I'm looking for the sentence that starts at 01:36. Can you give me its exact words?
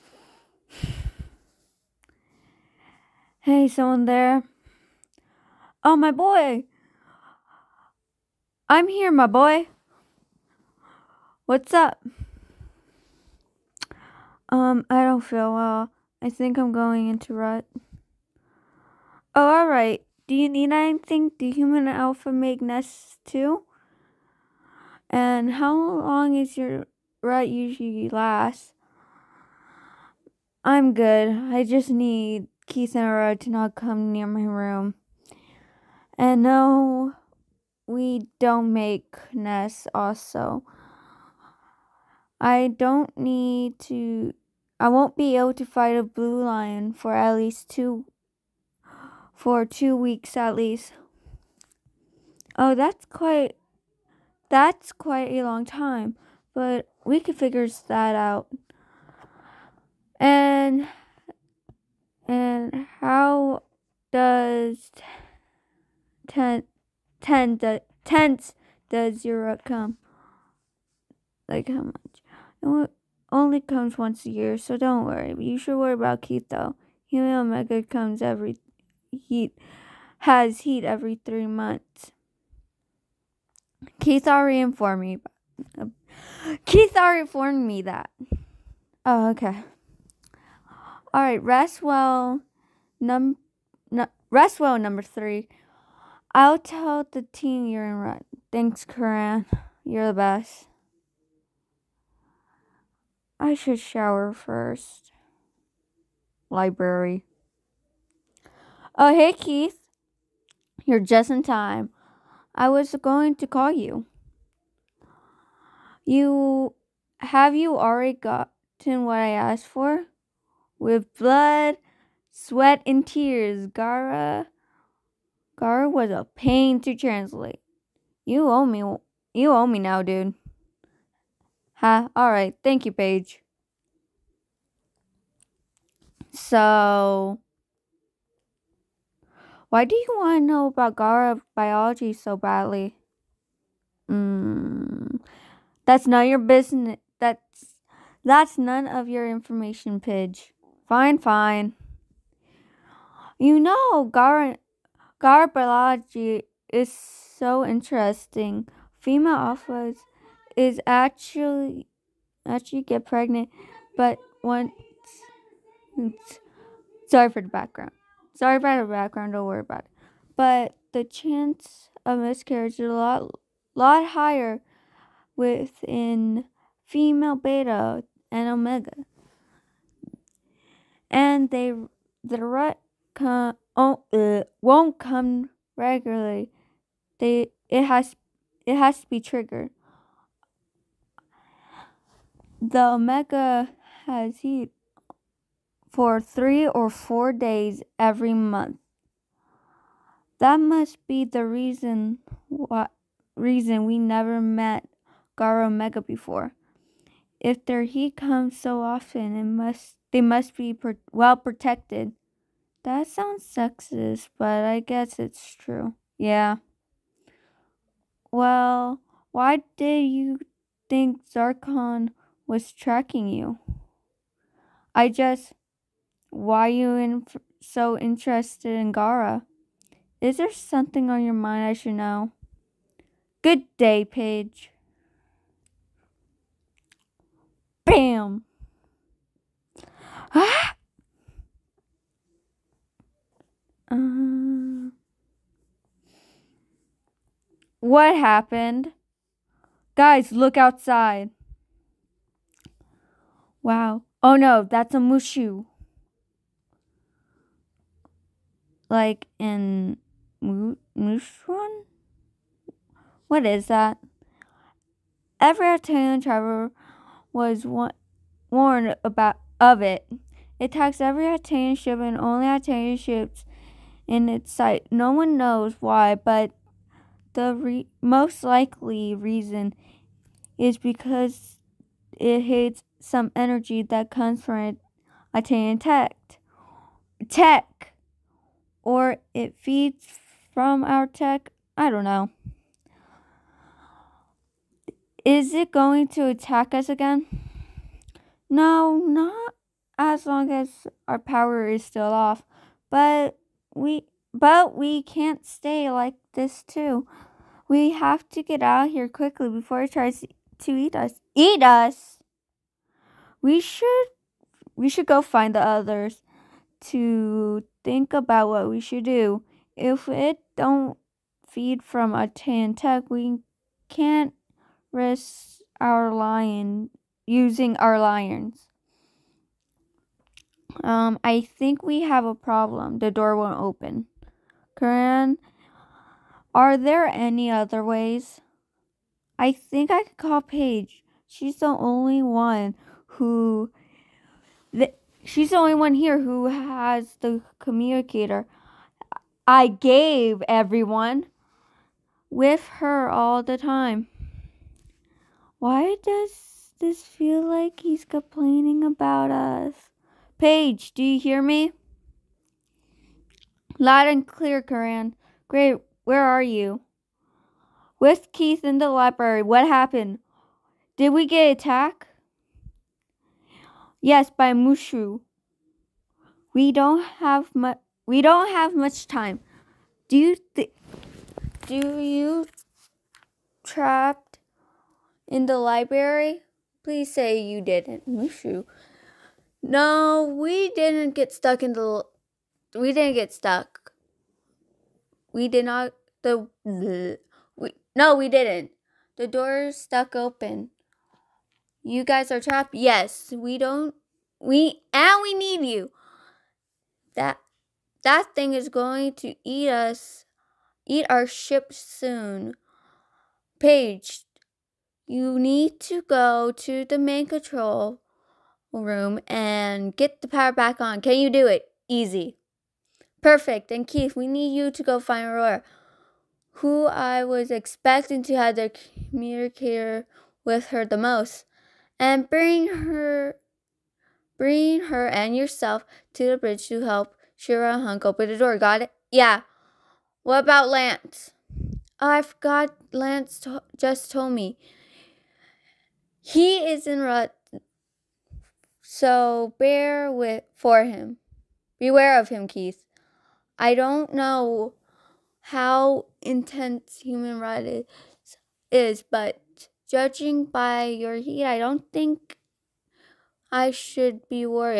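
I'll tell the team you're in right.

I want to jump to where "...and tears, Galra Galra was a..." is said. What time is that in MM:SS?
02:02.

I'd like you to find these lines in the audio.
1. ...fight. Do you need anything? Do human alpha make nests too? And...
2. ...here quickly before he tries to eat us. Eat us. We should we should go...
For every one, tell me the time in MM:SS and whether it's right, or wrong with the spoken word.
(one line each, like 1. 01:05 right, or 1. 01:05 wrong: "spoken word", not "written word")
1. 00:19 wrong: "alright", not "fight"
2. 05:08 right.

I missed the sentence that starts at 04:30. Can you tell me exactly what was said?
It attacks every Altean ship and only Altean ships in its sight.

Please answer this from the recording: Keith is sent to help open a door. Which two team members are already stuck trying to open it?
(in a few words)
Shiro and Hunk.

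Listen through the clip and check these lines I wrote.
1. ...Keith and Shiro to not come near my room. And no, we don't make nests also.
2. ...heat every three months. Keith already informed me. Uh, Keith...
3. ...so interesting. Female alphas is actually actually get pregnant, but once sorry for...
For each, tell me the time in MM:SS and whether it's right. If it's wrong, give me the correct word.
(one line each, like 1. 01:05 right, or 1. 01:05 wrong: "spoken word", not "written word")
1. 00:32 wrong: "Aurora", not "Shiro"
2. 01:20 right
3. 02:36 right.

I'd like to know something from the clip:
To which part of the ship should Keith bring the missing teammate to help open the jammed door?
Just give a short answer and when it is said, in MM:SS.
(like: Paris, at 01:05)
The bridge, at 07:16.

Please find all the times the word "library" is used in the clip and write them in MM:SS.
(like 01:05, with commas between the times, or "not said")
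01:46, 06:08, 06:25.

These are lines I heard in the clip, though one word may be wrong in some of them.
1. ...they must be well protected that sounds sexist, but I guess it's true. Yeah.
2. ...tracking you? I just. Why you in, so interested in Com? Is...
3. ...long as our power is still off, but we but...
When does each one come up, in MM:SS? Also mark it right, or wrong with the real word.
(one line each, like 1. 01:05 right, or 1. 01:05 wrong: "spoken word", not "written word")
1. 03:30 right
2. 03:42 wrong: "Galra", not "Com"
3. 05:00 right.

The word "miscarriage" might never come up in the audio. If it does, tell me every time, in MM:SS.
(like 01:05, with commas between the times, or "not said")
02:52.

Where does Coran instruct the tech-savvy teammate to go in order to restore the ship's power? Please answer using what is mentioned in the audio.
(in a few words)
Main control room.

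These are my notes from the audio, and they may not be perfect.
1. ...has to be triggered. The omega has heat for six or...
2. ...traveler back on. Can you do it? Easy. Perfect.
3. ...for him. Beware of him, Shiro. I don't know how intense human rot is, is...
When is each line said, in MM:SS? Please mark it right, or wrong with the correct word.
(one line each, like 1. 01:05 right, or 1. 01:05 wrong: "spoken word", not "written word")
1. 03:08 wrong: "three", not "six"
2. 07:00 wrong: "power", not "traveler"
3. 07:30 wrong: "Keith", not "Shiro".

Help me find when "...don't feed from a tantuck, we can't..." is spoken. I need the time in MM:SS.
05:20.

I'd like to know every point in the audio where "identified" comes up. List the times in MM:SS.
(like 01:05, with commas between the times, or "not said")
not said.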